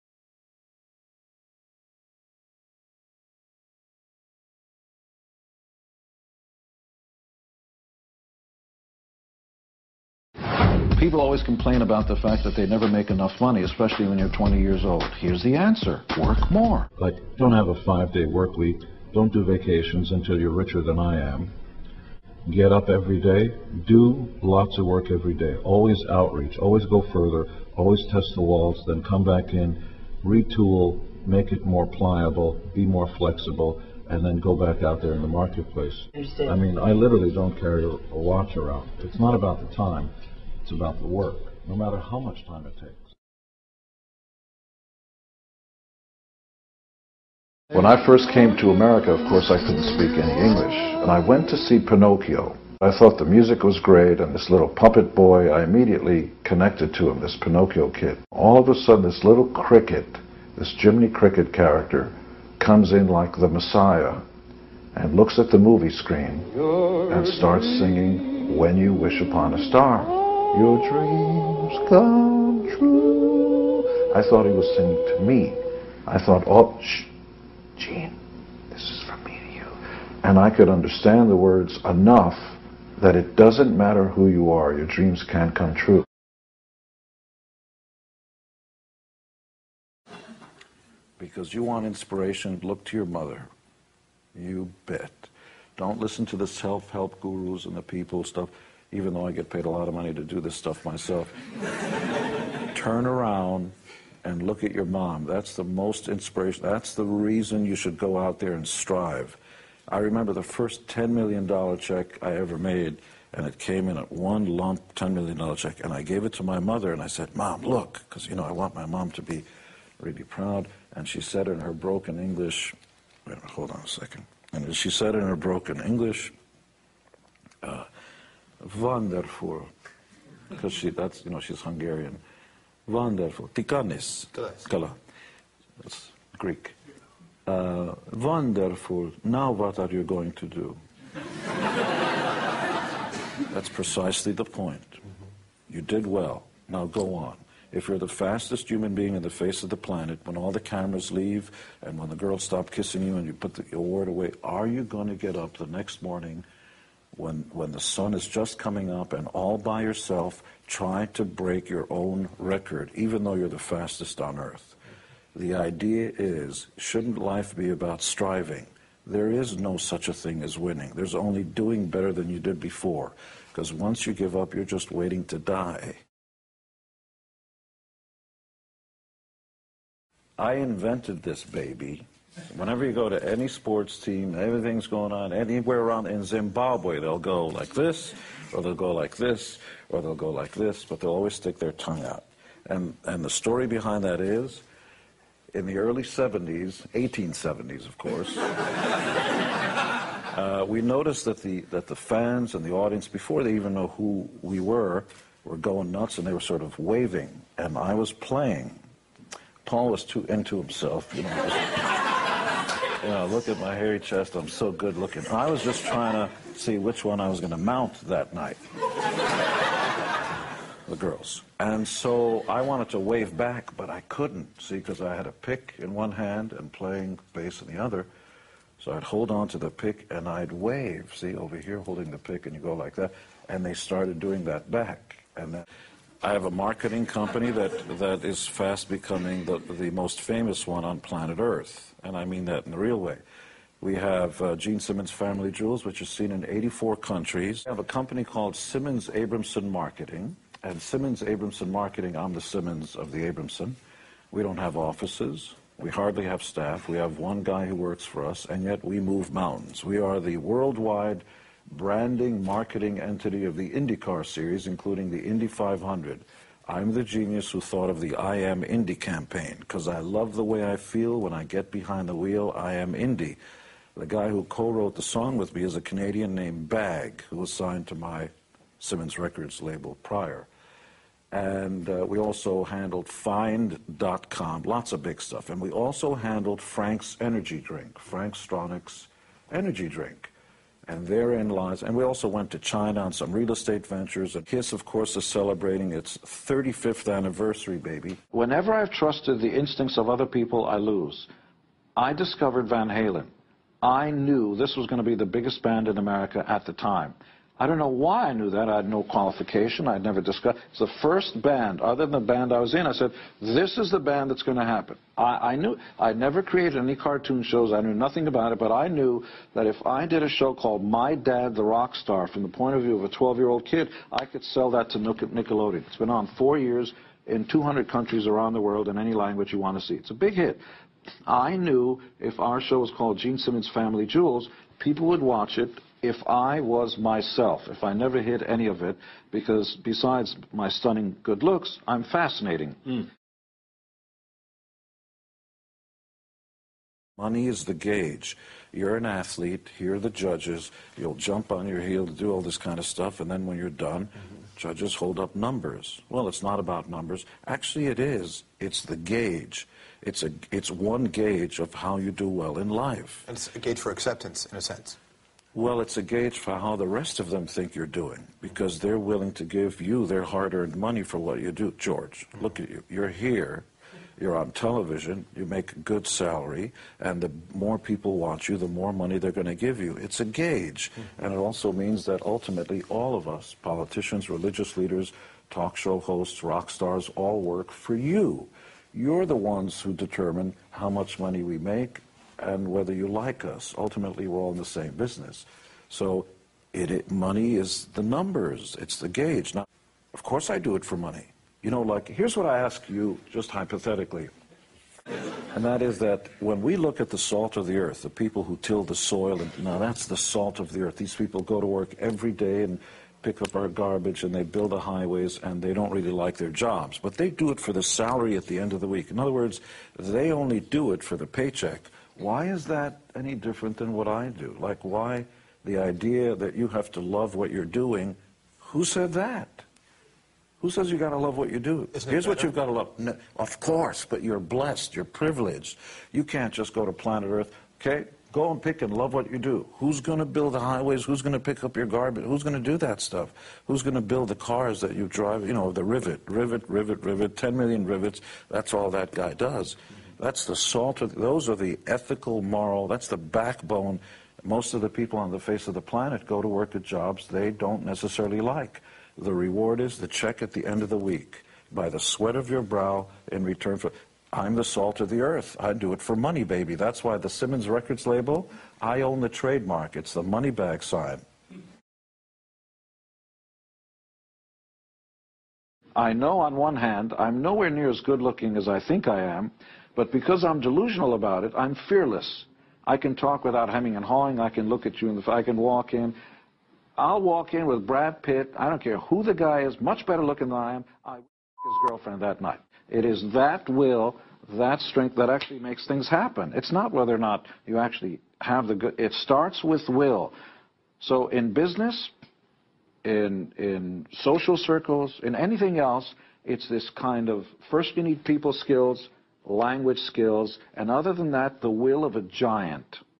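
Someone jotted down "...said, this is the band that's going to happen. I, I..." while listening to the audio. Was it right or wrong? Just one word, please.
right.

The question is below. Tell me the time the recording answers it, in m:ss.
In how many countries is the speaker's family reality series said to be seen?
4:06.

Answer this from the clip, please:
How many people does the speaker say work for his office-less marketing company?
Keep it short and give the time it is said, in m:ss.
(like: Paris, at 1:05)
1, at 4:17.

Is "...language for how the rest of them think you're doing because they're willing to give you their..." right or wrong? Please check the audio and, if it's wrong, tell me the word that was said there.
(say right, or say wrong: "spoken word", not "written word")
wrong: "gauge", not "language".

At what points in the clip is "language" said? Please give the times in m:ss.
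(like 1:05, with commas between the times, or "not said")
5:29, 8:29.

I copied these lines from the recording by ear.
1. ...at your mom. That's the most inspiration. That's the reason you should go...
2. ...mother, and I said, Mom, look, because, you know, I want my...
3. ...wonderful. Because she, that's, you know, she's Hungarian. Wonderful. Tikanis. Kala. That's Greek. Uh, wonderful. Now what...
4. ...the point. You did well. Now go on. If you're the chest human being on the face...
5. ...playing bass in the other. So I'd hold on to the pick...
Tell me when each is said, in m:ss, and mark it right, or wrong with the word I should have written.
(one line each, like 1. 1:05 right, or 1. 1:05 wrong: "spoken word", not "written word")
1. 1:44 right
2. 1:56 right
3. 2:08 right
4. 2:24 wrong: "fastest", not "chest"
5. 3:46 right.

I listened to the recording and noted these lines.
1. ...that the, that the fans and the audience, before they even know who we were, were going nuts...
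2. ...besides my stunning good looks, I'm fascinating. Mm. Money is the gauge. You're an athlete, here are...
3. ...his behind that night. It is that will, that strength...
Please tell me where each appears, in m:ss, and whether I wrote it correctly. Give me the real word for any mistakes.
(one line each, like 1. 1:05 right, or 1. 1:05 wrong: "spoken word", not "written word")
1. 3:21 right
2. 5:39 right
3. 8:11 wrong: "girlfriend", not "behind".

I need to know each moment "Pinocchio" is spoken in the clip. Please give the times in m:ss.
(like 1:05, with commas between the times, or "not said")
0:51, 0:57.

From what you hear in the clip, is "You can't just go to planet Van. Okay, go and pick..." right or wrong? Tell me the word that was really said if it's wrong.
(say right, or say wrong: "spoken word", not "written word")
wrong: "Earth", not "Van".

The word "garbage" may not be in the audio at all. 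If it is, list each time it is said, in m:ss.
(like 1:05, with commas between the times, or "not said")
6:53, 7:21.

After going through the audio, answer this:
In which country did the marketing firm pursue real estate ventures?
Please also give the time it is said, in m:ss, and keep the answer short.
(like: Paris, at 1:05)
China, at 4:52.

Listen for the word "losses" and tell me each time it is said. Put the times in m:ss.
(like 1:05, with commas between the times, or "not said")
not said.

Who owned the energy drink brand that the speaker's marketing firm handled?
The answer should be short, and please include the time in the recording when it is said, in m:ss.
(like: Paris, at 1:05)
Frank Stronach, at 4:47.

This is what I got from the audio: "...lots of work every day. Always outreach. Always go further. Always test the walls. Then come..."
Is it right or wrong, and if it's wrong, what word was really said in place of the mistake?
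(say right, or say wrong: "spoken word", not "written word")
right.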